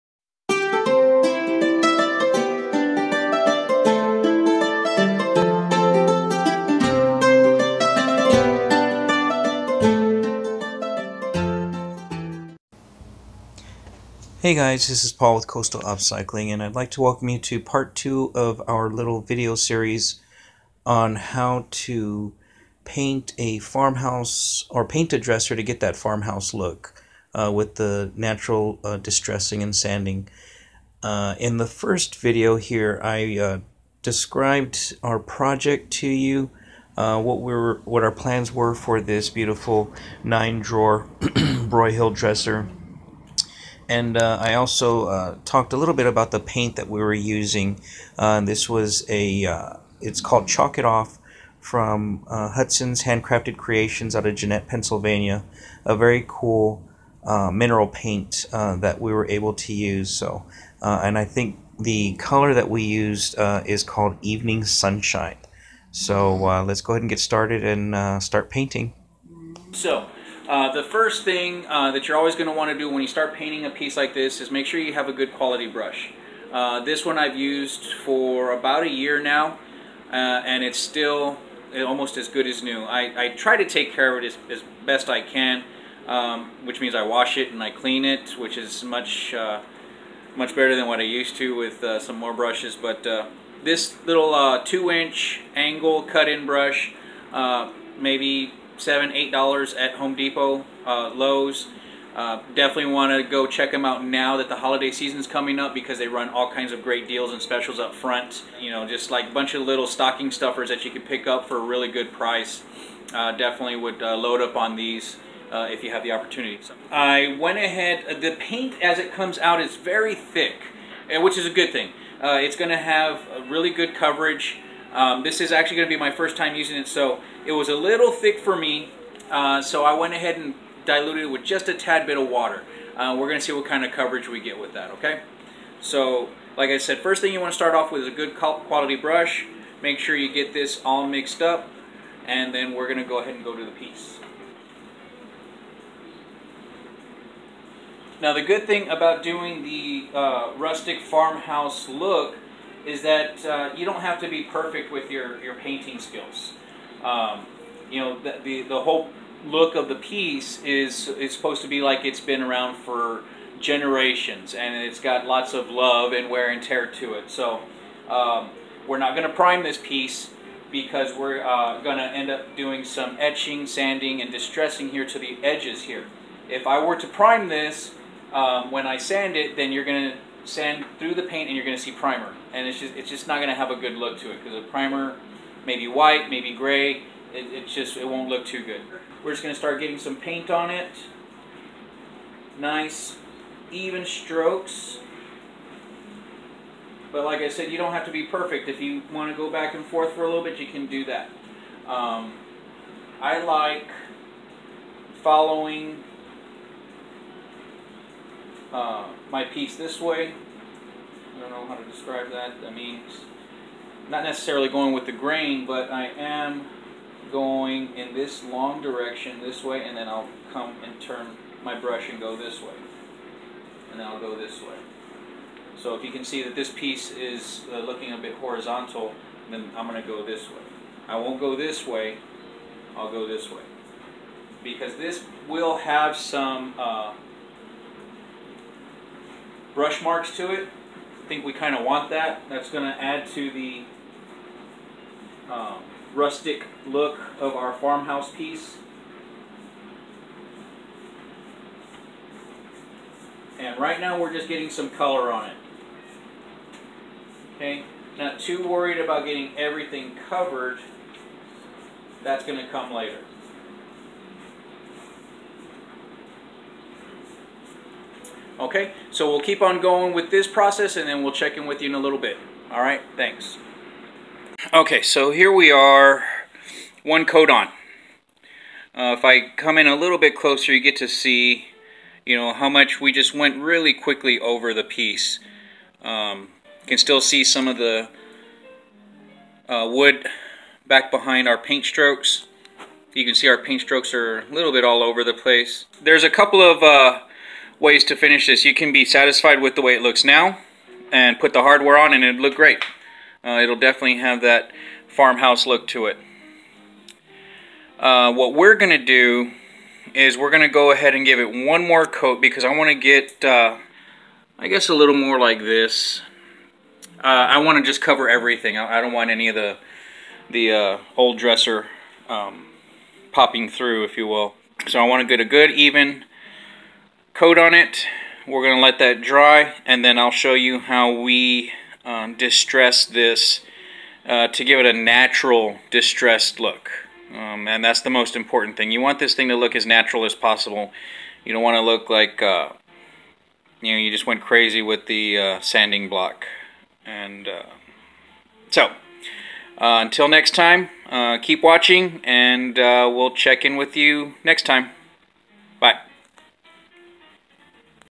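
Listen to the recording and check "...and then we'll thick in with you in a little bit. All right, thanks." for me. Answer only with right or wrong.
wrong.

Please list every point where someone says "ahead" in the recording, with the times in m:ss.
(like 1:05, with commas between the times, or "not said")
1:06, 1:57, 2:10, 2:23, 5:10.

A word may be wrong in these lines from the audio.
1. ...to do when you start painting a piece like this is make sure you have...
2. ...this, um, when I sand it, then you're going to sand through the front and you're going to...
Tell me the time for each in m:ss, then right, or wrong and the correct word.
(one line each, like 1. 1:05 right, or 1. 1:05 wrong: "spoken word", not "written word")
1. 1:12 right
2. 2:57 wrong: "paint", not "front".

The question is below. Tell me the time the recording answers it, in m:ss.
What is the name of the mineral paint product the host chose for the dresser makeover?
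0:50.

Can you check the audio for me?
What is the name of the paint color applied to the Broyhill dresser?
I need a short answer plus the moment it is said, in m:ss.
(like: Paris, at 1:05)
Evening Sunshine, at 1:04.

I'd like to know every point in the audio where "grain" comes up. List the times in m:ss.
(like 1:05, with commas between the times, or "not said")
3:35.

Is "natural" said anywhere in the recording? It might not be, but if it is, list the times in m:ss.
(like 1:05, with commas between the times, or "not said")
0:28, 5:34, 5:39.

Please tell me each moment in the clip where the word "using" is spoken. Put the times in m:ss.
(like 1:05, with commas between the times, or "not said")
0:47, 2:06.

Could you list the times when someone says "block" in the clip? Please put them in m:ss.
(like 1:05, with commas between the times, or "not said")
5:46.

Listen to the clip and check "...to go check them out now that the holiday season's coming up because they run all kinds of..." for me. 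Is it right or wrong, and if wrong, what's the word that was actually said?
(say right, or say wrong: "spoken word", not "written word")
right.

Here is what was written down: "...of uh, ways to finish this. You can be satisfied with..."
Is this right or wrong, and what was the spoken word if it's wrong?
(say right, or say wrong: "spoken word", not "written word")
right.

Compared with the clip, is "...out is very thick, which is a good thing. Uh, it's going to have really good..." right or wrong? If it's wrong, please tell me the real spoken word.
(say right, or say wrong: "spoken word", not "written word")
right.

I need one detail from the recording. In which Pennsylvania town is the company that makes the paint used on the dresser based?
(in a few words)
Jeannette.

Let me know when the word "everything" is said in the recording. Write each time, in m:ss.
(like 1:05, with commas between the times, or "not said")
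4:19, 5:18.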